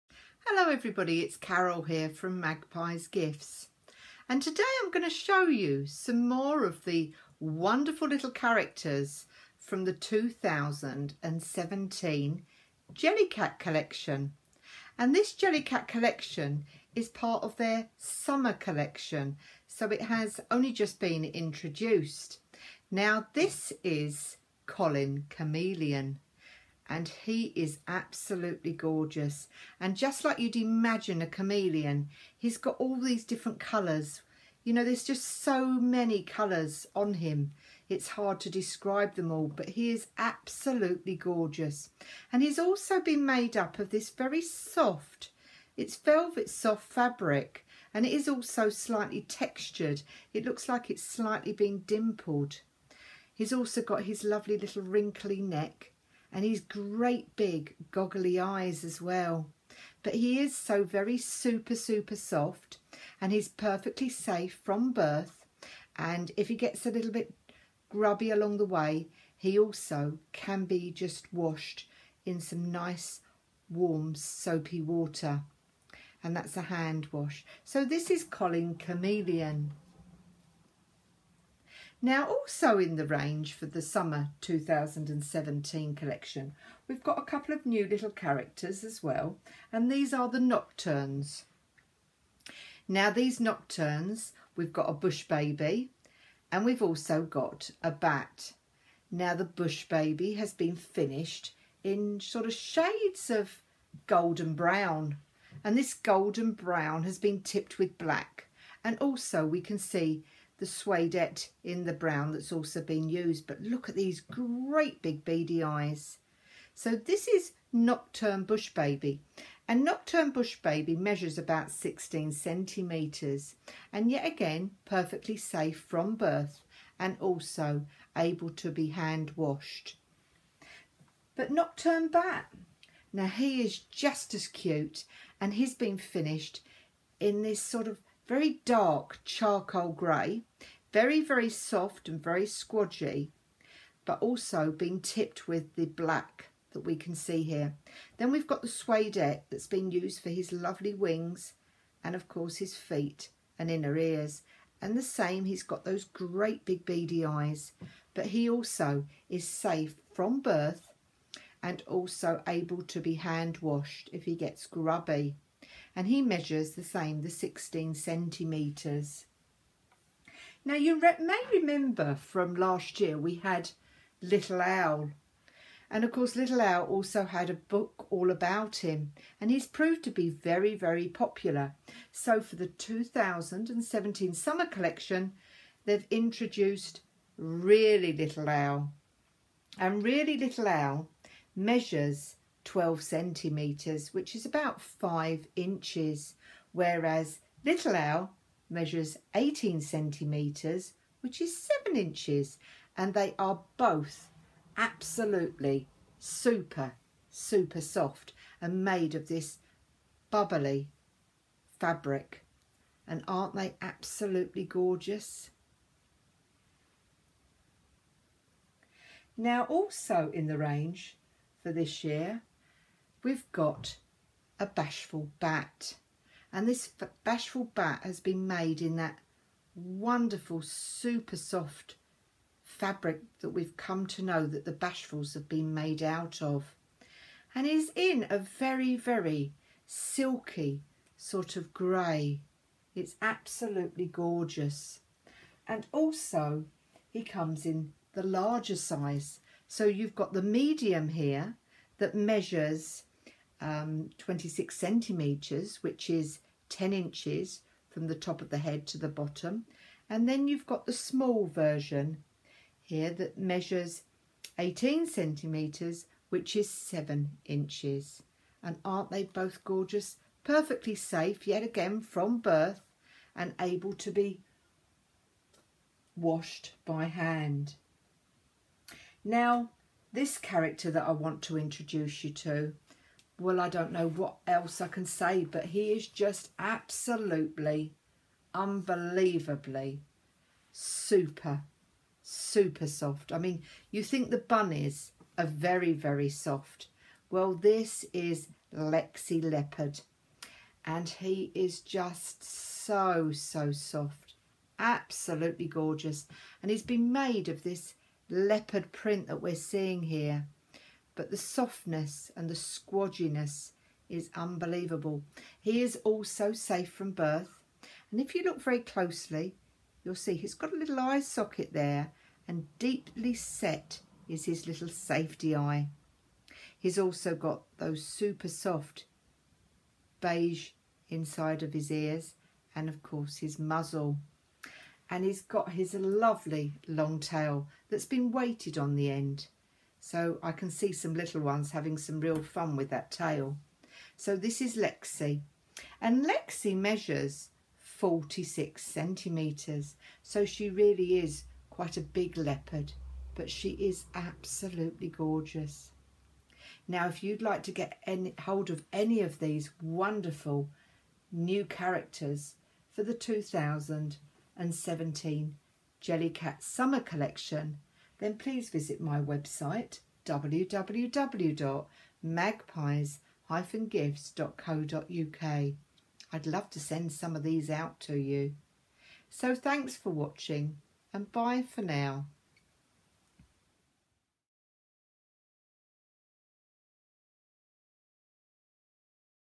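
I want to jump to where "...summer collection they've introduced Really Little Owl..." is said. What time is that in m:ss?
3:04.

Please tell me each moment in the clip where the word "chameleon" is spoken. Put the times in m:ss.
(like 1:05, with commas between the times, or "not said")
0:25, 0:31, 1:18.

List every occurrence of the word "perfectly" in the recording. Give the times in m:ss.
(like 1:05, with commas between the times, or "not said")
1:03, 2:04, 4:30.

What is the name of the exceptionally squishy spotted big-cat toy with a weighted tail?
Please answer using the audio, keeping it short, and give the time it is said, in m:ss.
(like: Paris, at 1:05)
Lexi Leopard, at 4:58.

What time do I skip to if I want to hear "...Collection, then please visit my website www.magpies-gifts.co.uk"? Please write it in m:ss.
6:06.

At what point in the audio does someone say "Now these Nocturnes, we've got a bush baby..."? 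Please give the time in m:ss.
1:32.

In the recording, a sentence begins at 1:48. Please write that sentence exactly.
And also we can see the suede in the brown that's also been used.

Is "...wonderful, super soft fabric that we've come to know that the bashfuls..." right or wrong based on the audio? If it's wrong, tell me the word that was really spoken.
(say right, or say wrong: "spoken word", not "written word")
right.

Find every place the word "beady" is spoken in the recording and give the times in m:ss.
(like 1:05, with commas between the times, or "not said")
1:55, 2:36.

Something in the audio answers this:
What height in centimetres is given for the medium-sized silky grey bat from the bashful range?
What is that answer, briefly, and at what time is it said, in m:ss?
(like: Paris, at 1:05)
26 centimetres, at 4:14.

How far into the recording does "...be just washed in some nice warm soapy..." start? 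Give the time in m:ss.
1:10.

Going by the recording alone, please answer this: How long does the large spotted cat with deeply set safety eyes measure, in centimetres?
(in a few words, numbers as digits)
46 centimetres.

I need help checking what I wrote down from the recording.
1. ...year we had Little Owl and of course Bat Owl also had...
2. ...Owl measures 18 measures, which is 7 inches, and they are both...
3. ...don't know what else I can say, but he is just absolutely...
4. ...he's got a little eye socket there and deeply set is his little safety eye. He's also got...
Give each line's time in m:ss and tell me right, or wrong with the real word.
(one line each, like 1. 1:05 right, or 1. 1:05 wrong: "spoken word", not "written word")
1. 2:52 wrong: "Little", not "Bat"
2. 3:17 wrong: "centimetres", not "measures"
3. 4:43 right
4. 5:20 right.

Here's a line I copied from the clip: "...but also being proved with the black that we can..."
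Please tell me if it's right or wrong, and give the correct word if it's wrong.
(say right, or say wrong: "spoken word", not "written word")
wrong: "tipped", not "proved".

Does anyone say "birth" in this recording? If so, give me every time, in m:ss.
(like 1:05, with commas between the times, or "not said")
1:04, 2:06, 2:40, 4:32, 5:17.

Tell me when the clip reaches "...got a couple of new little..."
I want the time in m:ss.
1:27.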